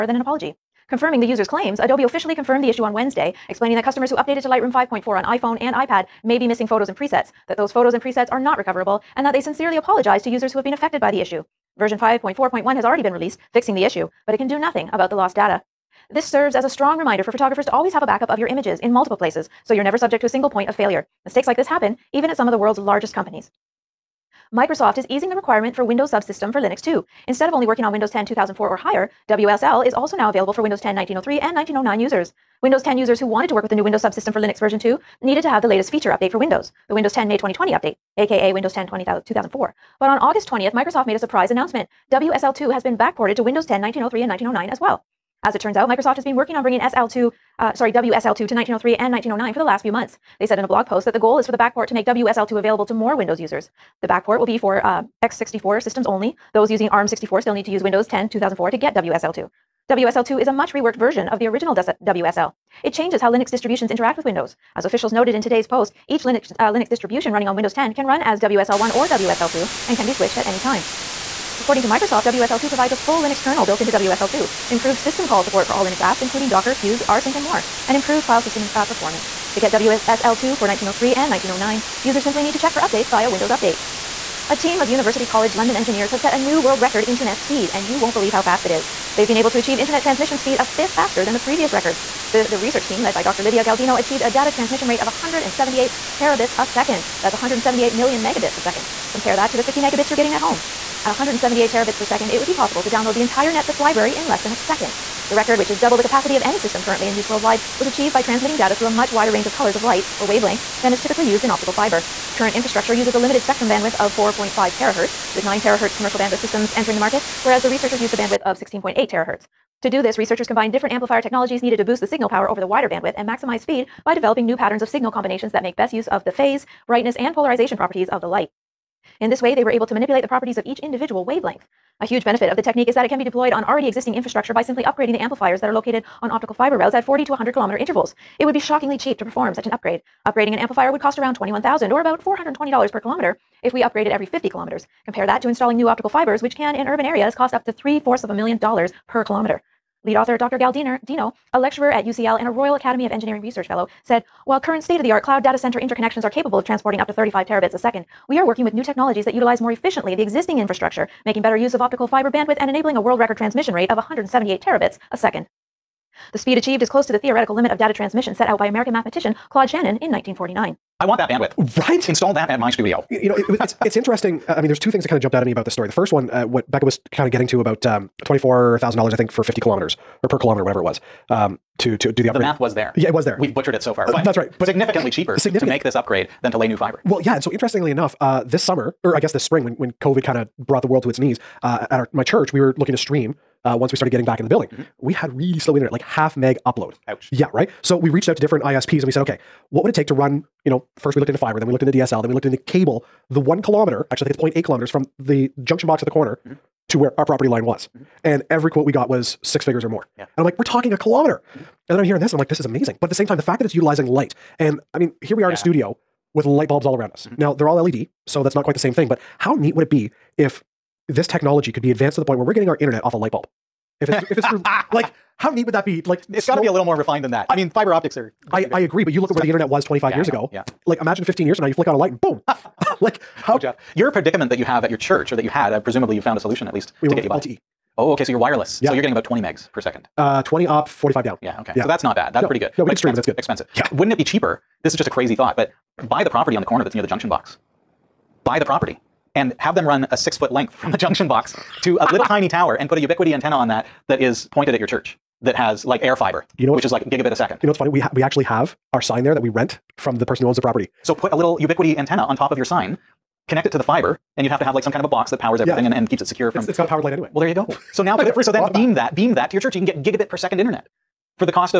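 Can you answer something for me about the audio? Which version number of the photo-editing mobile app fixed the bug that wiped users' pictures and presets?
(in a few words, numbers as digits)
5.4.1.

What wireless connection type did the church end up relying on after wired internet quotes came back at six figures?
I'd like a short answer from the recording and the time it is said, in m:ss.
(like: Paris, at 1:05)
LTE, at 3:57.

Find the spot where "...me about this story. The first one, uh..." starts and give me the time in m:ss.
2:55.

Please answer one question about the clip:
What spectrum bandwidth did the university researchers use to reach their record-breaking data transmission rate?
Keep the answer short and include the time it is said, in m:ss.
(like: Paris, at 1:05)
16.8 terahertz, at 1:58.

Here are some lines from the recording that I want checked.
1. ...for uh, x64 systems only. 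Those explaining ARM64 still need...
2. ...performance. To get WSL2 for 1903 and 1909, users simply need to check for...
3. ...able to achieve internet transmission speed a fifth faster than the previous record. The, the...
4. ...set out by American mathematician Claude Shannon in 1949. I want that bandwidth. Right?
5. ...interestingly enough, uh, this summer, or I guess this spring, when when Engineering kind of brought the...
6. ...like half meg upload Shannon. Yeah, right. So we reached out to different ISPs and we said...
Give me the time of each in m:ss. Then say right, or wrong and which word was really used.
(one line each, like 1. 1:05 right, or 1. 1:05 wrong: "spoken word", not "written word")
1. 0:54 wrong: "using", not "explaining"
2. 1:18 right
3. 1:29 right
4. 2:48 right
5. 3:07 wrong: "COVID", not "Engineering"
6. 3:15 wrong: "Ouch", not "Shannon".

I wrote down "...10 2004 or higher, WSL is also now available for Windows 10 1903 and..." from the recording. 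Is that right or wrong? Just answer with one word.
right.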